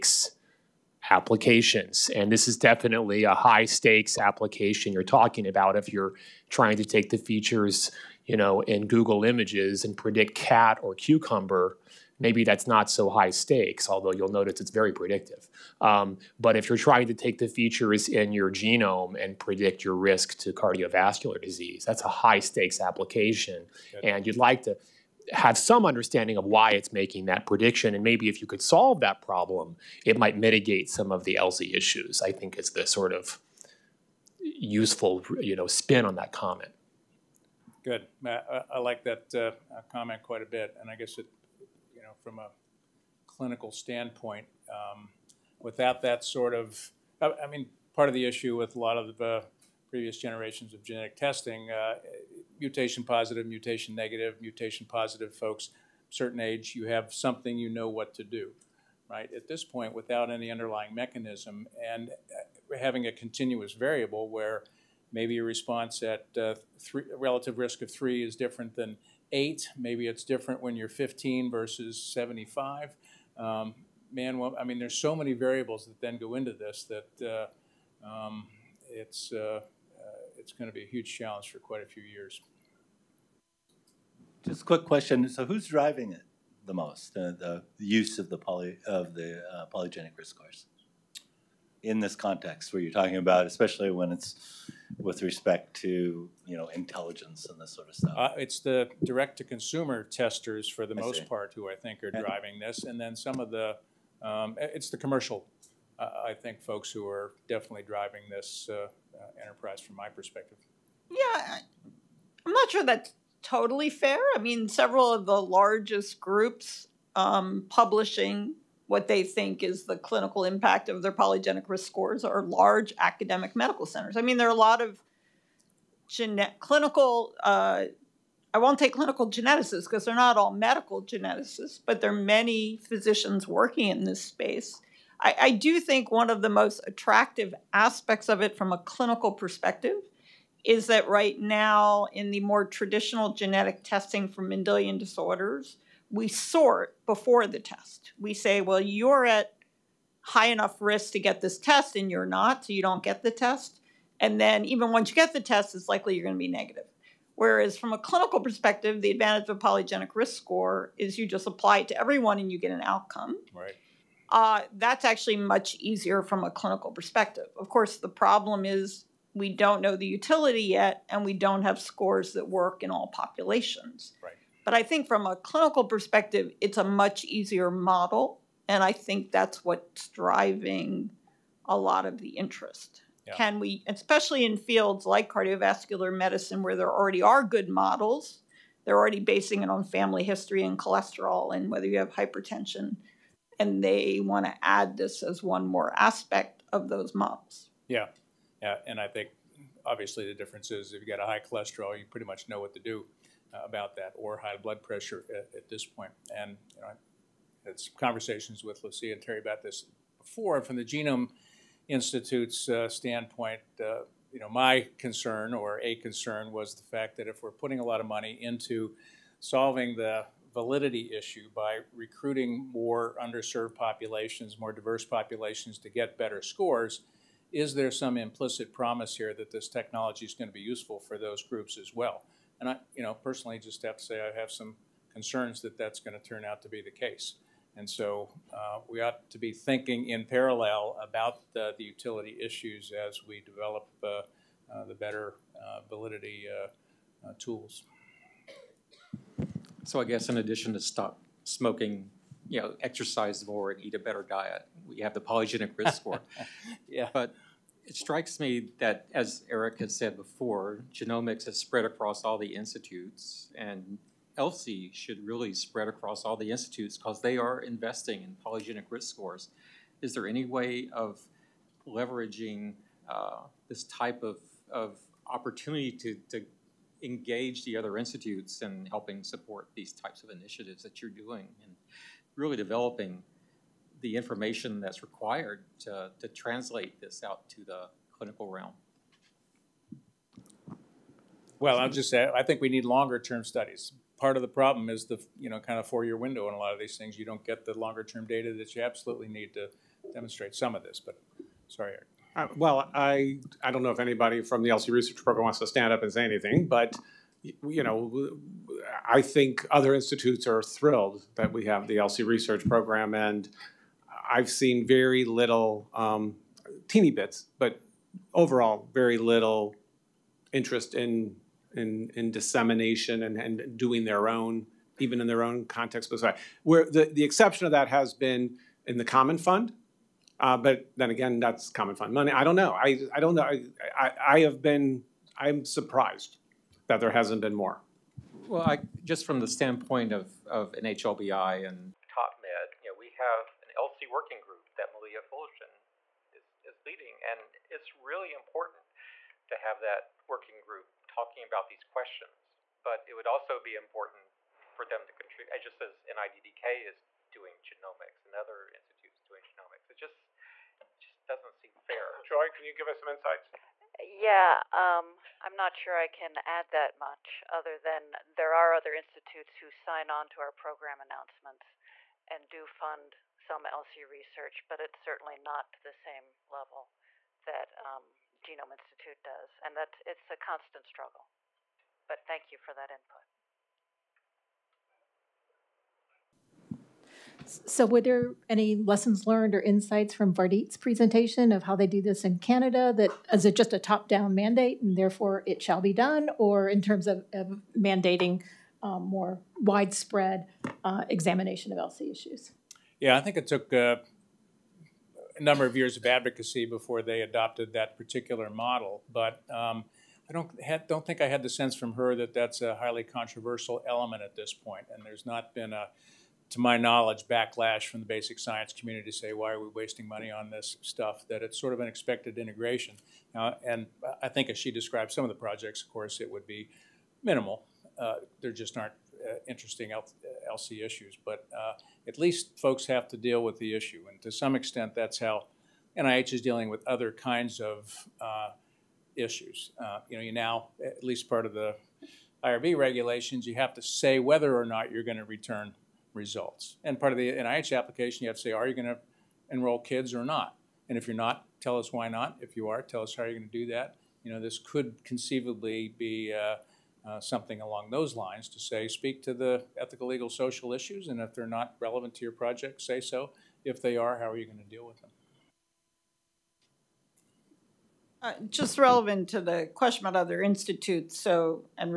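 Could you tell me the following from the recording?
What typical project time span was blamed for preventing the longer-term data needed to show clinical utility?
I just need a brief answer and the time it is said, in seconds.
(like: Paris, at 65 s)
4 years, at 295 s.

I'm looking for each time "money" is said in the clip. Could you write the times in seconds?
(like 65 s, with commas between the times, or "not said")
218 s, 332 s, 420 s.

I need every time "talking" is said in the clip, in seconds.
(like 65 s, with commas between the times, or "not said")
5 s, 92 s, 351 s.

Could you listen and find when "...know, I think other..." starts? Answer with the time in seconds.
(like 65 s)
307 s.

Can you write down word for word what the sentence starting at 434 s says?
And to some extent, that's how NIH is dealing with other kinds of uh, issues.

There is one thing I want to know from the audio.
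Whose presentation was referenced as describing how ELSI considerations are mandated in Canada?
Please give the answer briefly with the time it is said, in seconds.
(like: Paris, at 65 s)
Vardit, at 390 s.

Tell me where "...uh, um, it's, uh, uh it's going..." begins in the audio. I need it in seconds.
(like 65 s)
78 s.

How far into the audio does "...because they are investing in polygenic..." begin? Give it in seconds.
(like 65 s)
266 s.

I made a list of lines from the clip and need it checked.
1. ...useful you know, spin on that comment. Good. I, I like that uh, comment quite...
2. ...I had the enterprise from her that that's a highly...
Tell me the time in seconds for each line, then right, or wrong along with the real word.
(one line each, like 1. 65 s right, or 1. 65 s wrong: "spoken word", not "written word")
1. 34 s right
2. 411 s wrong: "sense", not "enterprise".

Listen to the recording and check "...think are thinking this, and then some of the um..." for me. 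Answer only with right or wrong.
wrong.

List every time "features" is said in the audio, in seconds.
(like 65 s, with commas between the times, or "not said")
7 s, 17 s.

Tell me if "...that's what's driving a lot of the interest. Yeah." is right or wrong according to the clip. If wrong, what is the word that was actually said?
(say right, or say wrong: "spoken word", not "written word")
right.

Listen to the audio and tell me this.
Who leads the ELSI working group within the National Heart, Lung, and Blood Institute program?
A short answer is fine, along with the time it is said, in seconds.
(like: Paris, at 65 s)
Malia Fullerton, at 344 s.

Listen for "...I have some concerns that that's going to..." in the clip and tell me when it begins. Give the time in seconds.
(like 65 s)
234 s.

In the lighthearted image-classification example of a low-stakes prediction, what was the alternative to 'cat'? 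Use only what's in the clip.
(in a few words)
cucumber.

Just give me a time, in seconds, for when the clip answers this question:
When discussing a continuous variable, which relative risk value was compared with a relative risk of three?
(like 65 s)
69 s.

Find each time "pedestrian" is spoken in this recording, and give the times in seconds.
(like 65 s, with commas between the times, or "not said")
not said.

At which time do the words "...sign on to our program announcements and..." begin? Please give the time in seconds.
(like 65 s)
369 s.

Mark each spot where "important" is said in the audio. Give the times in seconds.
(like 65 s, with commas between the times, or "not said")
348 s, 353 s.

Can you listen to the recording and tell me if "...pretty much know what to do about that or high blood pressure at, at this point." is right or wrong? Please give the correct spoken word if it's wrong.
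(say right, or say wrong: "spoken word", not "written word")
right.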